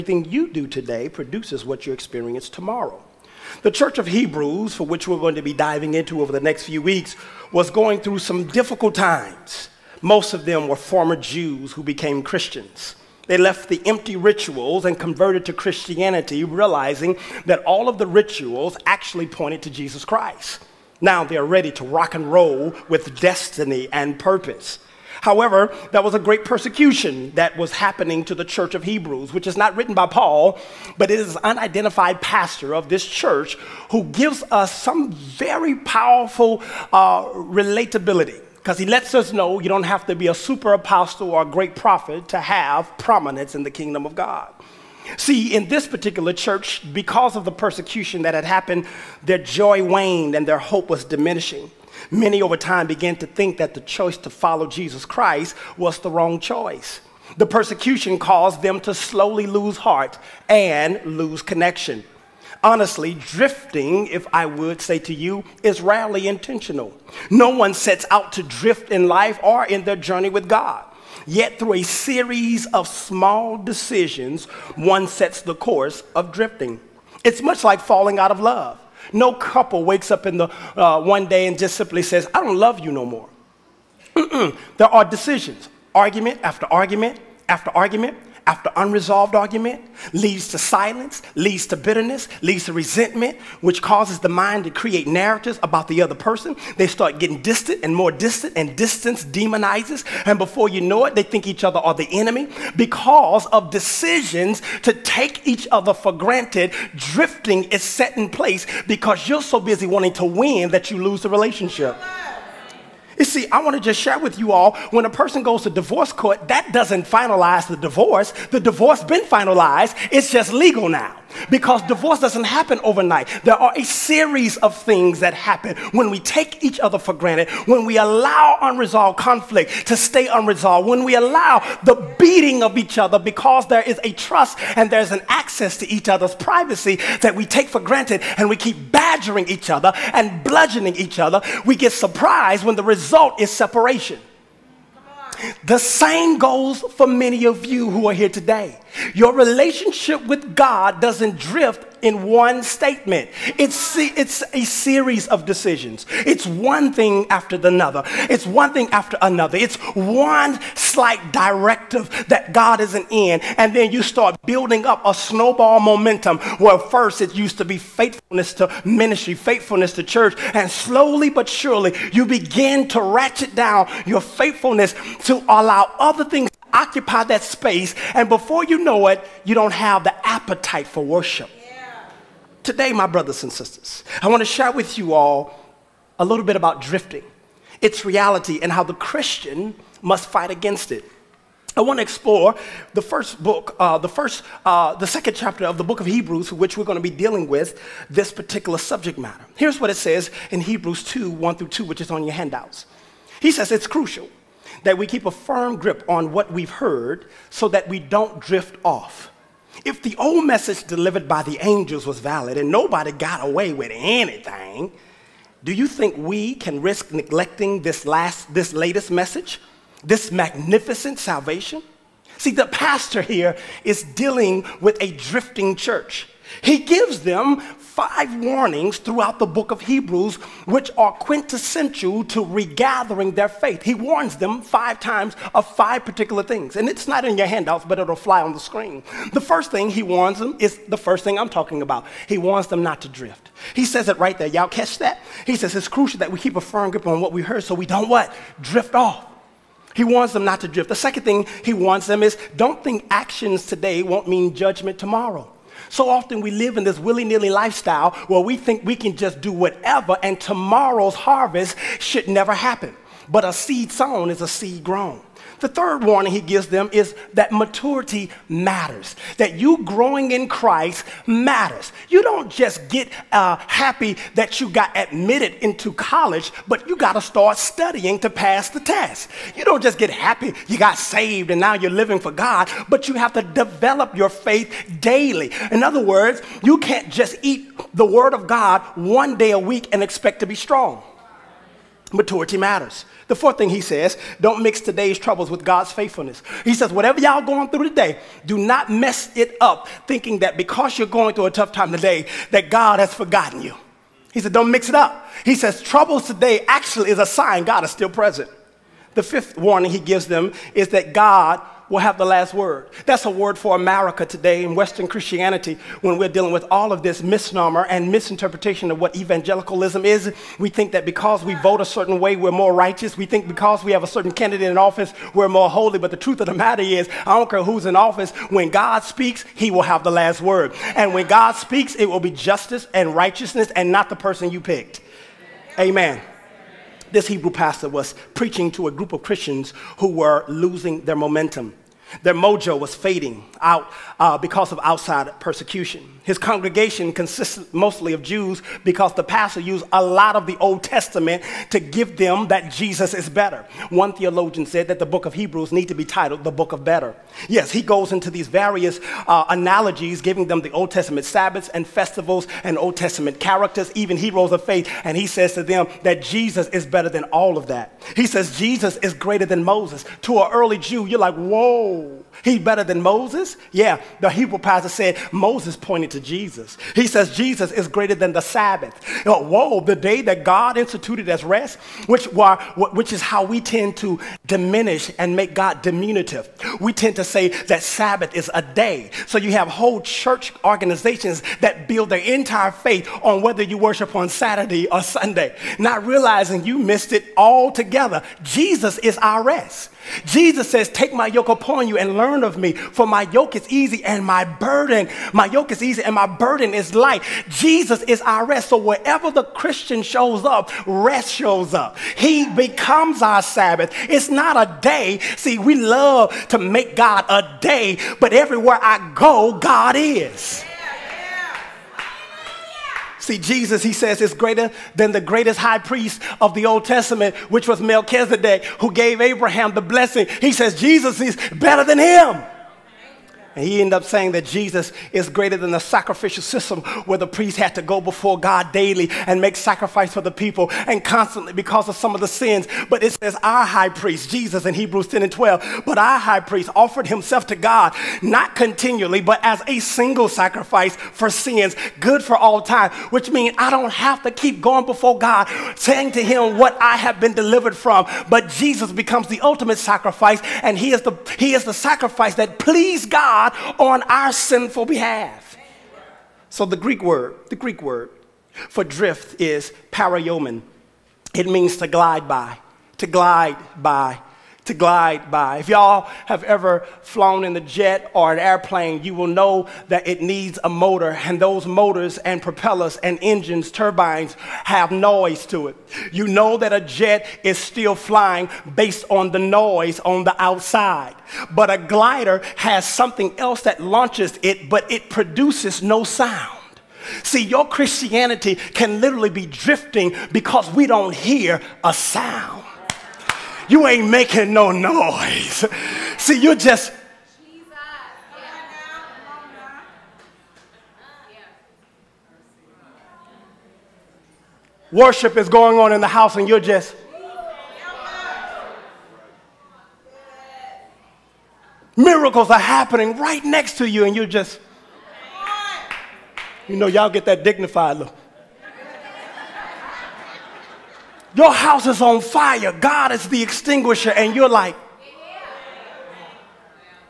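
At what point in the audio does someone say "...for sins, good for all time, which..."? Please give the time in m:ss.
7:30.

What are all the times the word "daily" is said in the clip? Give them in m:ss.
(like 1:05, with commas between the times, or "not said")
4:45, 7:18.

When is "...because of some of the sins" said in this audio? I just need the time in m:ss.
7:21.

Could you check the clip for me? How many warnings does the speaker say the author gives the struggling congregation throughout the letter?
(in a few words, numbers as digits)
5.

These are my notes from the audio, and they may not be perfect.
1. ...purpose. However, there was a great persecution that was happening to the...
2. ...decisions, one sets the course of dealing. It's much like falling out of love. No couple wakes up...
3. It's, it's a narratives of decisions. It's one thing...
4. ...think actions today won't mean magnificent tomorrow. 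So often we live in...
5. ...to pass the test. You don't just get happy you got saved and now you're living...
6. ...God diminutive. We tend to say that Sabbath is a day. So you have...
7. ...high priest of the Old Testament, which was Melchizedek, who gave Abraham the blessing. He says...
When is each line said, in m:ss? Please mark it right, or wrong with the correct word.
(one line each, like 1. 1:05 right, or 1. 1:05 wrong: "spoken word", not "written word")
1. 0:24 right
2. 1:13 wrong: "drifting", not "dealing"
3. 2:33 wrong: "series", not "narratives"
4. 4:12 wrong: "judgment", not "magnificent"
5. 4:38 right
6. 6:25 right
7. 7:05 right.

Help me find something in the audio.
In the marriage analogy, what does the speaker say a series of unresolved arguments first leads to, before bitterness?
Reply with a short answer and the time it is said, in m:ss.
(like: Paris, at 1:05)
Silence, at 1:30.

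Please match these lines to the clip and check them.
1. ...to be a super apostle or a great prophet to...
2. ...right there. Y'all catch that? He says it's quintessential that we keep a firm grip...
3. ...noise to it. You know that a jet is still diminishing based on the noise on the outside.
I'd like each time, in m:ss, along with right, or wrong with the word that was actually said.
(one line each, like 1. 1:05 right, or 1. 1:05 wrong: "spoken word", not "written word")
1. 0:40 right
2. 4:04 wrong: "crucial", not "quintessential"
3. 8:04 wrong: "flying", not "diminishing".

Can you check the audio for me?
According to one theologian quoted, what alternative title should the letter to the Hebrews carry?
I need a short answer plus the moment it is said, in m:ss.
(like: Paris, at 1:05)
The book of better, at 5:56.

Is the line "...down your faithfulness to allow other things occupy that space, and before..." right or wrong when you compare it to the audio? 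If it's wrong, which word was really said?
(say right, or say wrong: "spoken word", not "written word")
right.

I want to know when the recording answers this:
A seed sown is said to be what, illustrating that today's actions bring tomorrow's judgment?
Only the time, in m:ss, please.
4:24.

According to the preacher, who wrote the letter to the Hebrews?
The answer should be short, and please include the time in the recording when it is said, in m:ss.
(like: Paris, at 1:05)
An unidentified pastor, at 0:31.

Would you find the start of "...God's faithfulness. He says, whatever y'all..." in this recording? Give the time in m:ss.
4:55.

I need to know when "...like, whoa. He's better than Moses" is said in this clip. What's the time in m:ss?
6:11.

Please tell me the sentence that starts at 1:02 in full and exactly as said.
Honestly, drifting, if I would say to you, is rarely intentional.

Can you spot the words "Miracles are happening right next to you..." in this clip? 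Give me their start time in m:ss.
8:41.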